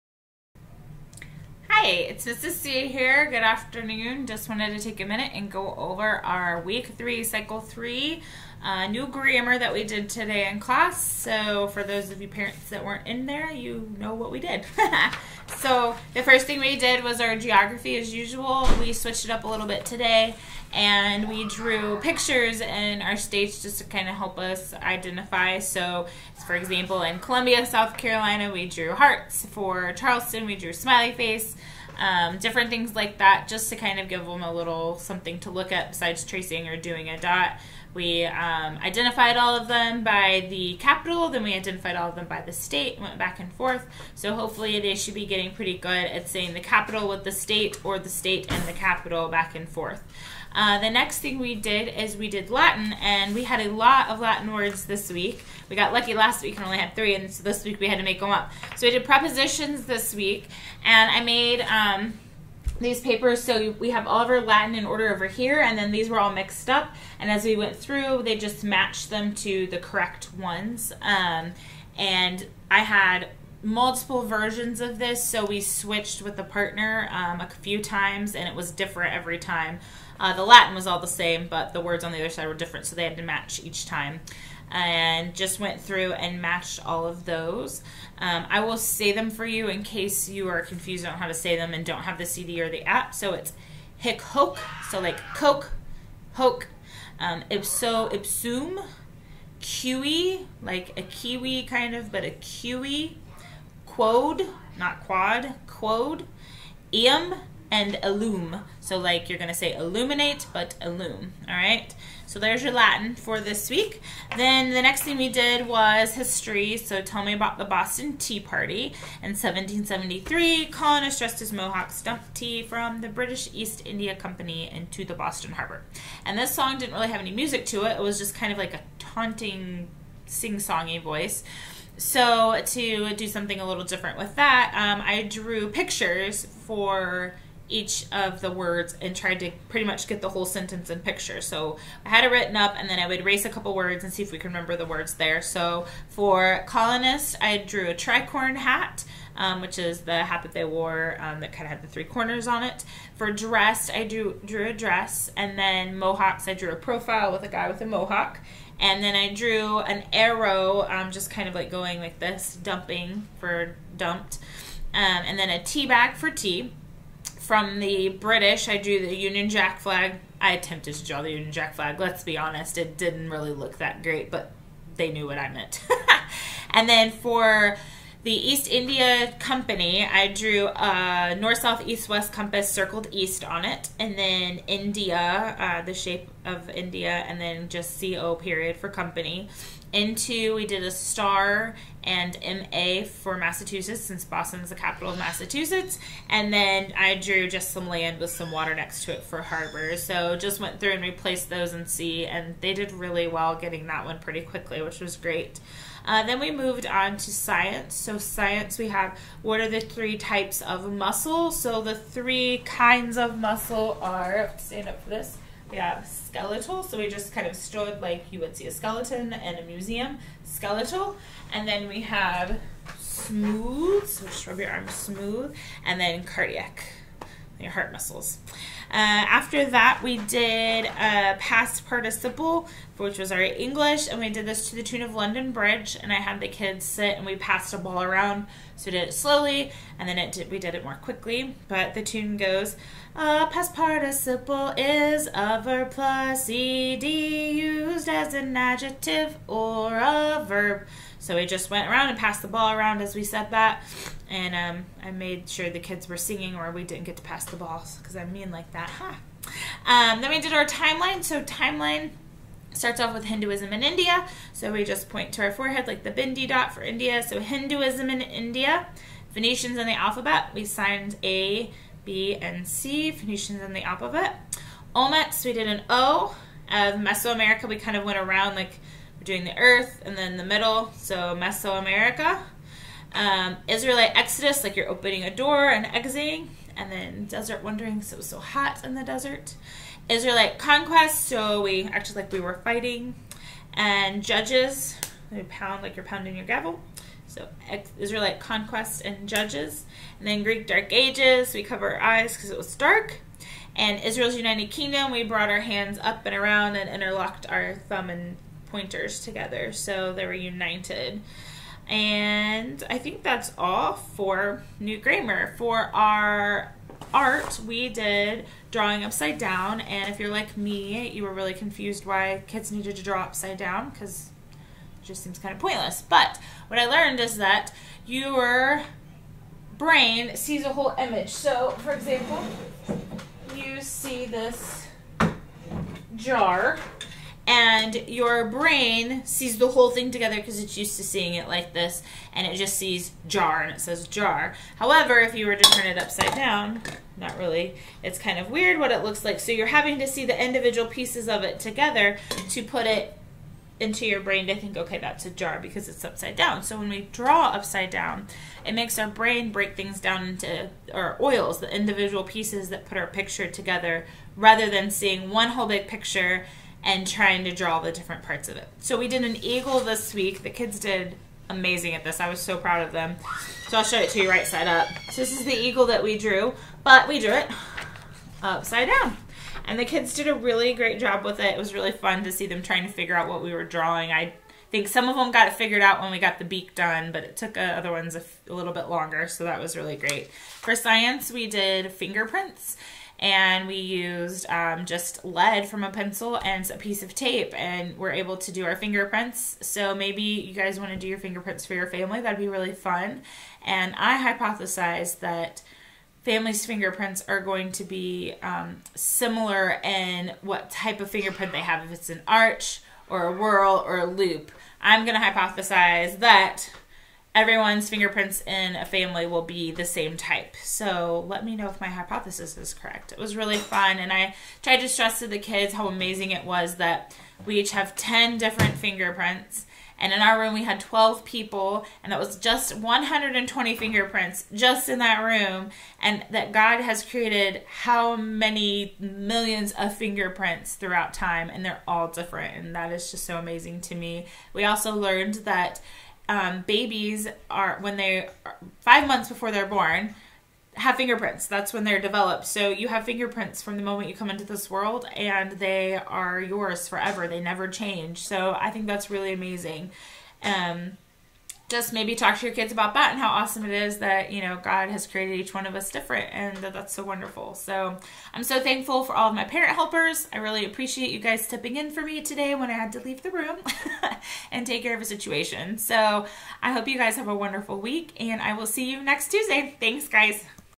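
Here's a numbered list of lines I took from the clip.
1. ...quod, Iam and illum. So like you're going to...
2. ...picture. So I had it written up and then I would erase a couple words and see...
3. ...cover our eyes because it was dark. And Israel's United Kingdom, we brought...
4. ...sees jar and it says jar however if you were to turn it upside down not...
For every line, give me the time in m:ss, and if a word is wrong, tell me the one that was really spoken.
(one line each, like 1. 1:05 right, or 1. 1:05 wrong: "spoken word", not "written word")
1. 1:45 right
2. 2:20 right
3. 5:01 right
4. 5:42 right.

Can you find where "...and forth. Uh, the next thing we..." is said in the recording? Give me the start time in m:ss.
0:49.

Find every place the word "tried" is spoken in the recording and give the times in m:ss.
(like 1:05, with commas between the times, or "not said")
2:19, 7:04.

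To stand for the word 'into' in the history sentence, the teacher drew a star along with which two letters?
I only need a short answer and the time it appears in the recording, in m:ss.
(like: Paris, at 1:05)
MA, at 3:12.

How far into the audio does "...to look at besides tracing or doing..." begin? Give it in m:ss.
0:35.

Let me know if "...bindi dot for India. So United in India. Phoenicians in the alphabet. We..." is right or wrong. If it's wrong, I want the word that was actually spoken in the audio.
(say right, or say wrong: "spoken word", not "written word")
wrong: "Hinduism", not "United".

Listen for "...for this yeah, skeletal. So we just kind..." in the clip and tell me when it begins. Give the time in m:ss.
3:35.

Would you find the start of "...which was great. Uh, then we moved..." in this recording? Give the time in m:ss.
3:24.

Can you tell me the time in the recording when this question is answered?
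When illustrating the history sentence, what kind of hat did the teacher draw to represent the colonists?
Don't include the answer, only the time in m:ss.
2:27.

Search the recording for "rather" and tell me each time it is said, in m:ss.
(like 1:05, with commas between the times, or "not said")
6:04.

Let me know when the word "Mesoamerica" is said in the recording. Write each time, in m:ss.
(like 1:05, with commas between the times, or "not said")
4:37, 4:41.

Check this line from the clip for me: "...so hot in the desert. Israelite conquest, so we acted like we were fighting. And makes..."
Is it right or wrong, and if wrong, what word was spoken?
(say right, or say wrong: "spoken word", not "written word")
wrong: "judges", not "makes".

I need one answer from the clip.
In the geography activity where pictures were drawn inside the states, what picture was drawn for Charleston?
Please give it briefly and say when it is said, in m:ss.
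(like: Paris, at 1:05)
smiley face, at 0:30.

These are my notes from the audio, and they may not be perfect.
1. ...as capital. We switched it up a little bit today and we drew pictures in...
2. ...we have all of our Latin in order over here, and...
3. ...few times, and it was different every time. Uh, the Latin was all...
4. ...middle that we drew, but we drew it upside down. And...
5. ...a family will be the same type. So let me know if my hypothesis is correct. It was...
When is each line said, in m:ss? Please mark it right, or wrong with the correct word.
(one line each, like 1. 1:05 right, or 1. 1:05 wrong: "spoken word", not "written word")
1. 0:17 wrong: "usual", not "capital"
2. 1:03 right
3. 1:17 right
4. 6:15 wrong: "eagle", not "middle"
5. 6:58 right.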